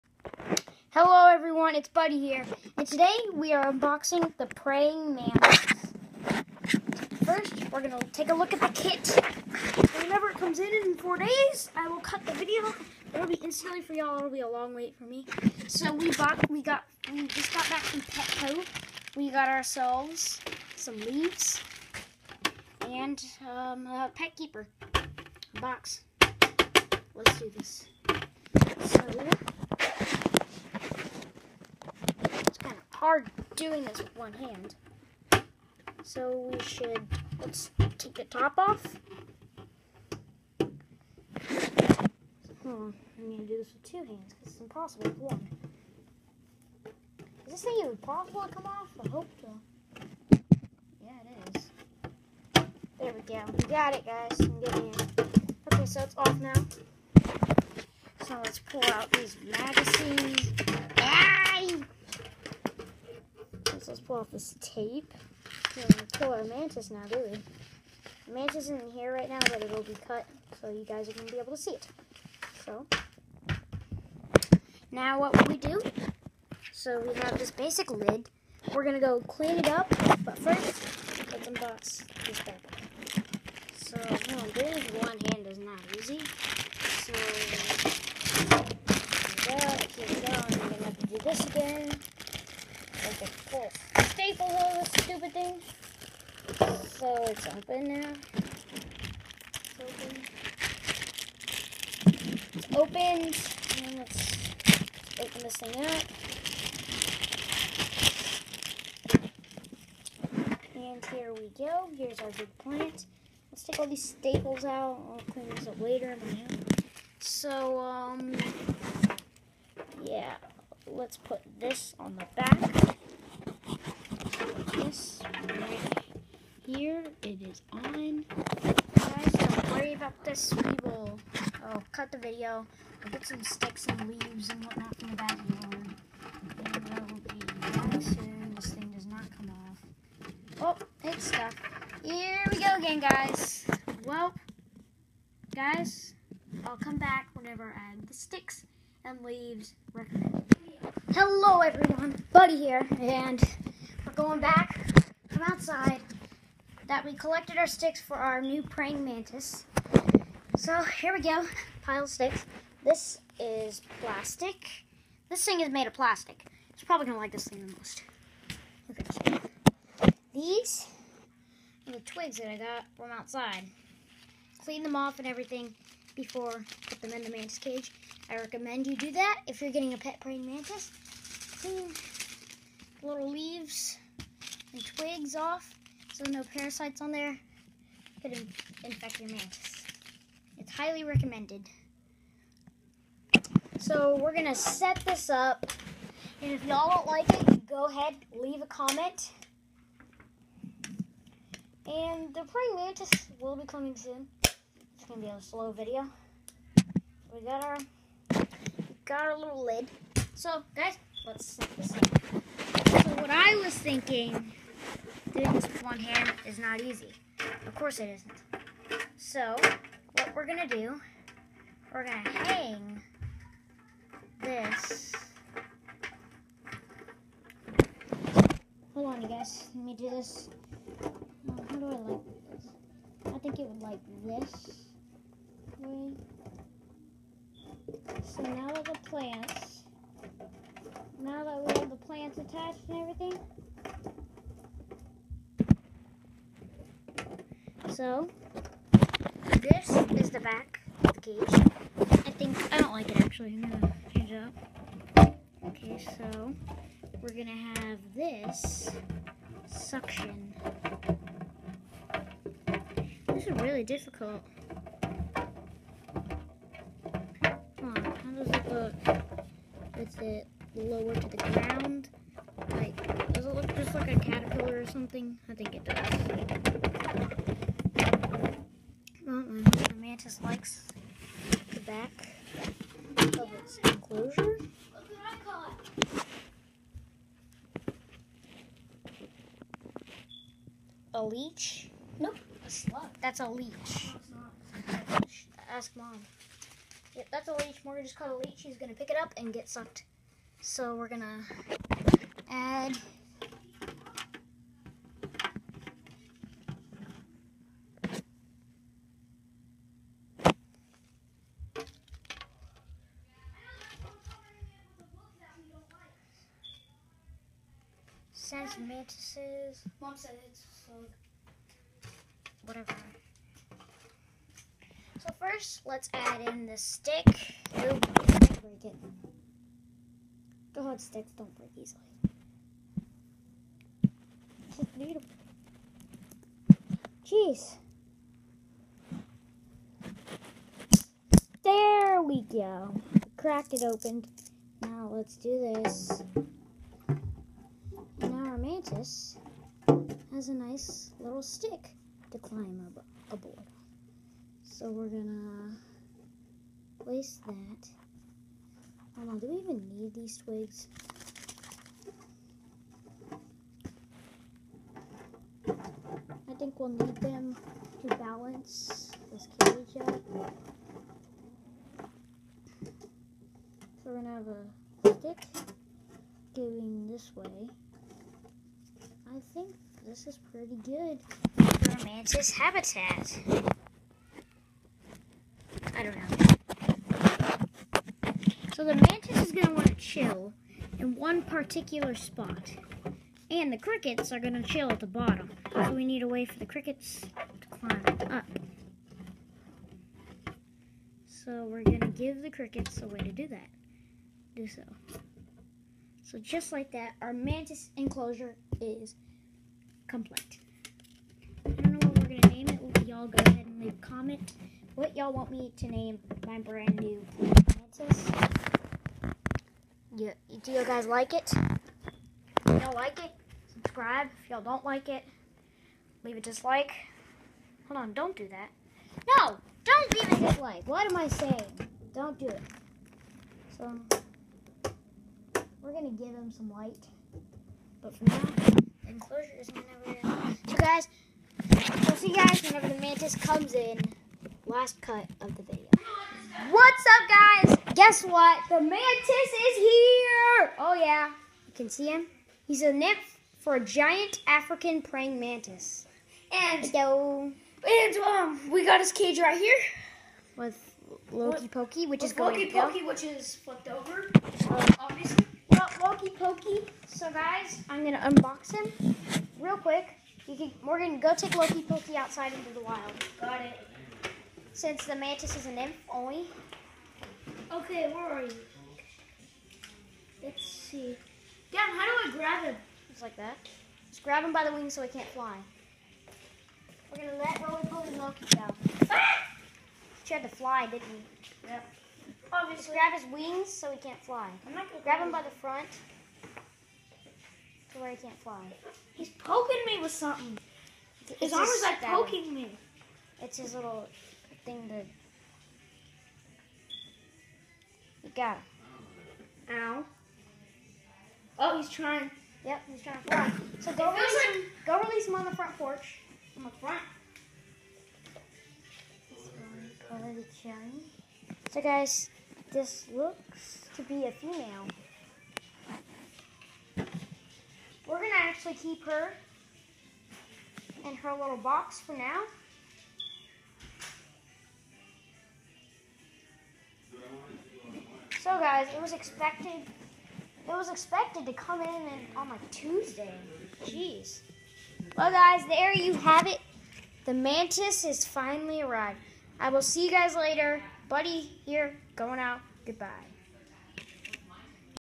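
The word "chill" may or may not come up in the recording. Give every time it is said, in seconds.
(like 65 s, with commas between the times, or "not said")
389 s, 394 s.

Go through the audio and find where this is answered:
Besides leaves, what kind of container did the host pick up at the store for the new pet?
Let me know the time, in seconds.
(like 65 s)
24 s.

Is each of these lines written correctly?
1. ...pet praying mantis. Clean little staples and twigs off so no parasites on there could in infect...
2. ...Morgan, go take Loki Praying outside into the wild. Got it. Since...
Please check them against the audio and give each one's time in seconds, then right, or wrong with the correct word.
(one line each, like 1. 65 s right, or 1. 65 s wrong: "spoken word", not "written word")
1. 179 s wrong: "leaves", not "staples"
2. 470 s wrong: "Pokey", not "Praying".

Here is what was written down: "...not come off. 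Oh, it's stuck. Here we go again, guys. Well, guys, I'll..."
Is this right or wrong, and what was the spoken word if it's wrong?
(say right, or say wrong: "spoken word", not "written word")
right.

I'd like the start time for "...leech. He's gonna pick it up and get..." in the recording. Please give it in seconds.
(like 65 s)
298 s.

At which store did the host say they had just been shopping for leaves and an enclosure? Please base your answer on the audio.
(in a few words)
Petco.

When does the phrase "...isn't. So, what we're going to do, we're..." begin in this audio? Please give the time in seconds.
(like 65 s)
218 s.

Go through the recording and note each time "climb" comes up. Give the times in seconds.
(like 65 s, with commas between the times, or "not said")
352 s, 397 s.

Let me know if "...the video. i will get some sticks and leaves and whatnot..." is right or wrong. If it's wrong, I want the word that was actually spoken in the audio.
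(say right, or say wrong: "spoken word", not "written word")
right.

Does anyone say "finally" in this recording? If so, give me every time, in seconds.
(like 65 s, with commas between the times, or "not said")
548 s.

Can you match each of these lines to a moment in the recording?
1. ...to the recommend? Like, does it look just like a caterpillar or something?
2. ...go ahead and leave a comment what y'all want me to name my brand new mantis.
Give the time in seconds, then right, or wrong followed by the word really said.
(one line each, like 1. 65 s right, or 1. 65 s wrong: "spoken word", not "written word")
1. 271 s wrong: "ground", not "recommend"
2. 413 s right.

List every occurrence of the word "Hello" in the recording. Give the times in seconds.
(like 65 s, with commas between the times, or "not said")
151 s, 456 s.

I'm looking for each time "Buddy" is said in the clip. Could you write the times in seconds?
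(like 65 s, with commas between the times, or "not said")
1 s, 152 s, 551 s.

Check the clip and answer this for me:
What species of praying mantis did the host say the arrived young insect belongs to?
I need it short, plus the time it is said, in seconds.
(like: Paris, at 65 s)
giant African praying mantis, at 453 s.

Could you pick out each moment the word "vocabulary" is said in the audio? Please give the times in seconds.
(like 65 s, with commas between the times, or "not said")
not said.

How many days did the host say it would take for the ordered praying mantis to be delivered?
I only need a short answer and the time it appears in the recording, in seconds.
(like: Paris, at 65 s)
4, at 10 s.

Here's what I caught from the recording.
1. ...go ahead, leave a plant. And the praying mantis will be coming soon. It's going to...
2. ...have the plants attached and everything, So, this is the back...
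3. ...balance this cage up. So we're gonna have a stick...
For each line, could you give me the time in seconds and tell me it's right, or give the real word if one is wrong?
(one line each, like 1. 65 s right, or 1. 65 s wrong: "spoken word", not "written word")
1. 197 s wrong: "comment", not "plant"
2. 241 s right
3. 368 s right.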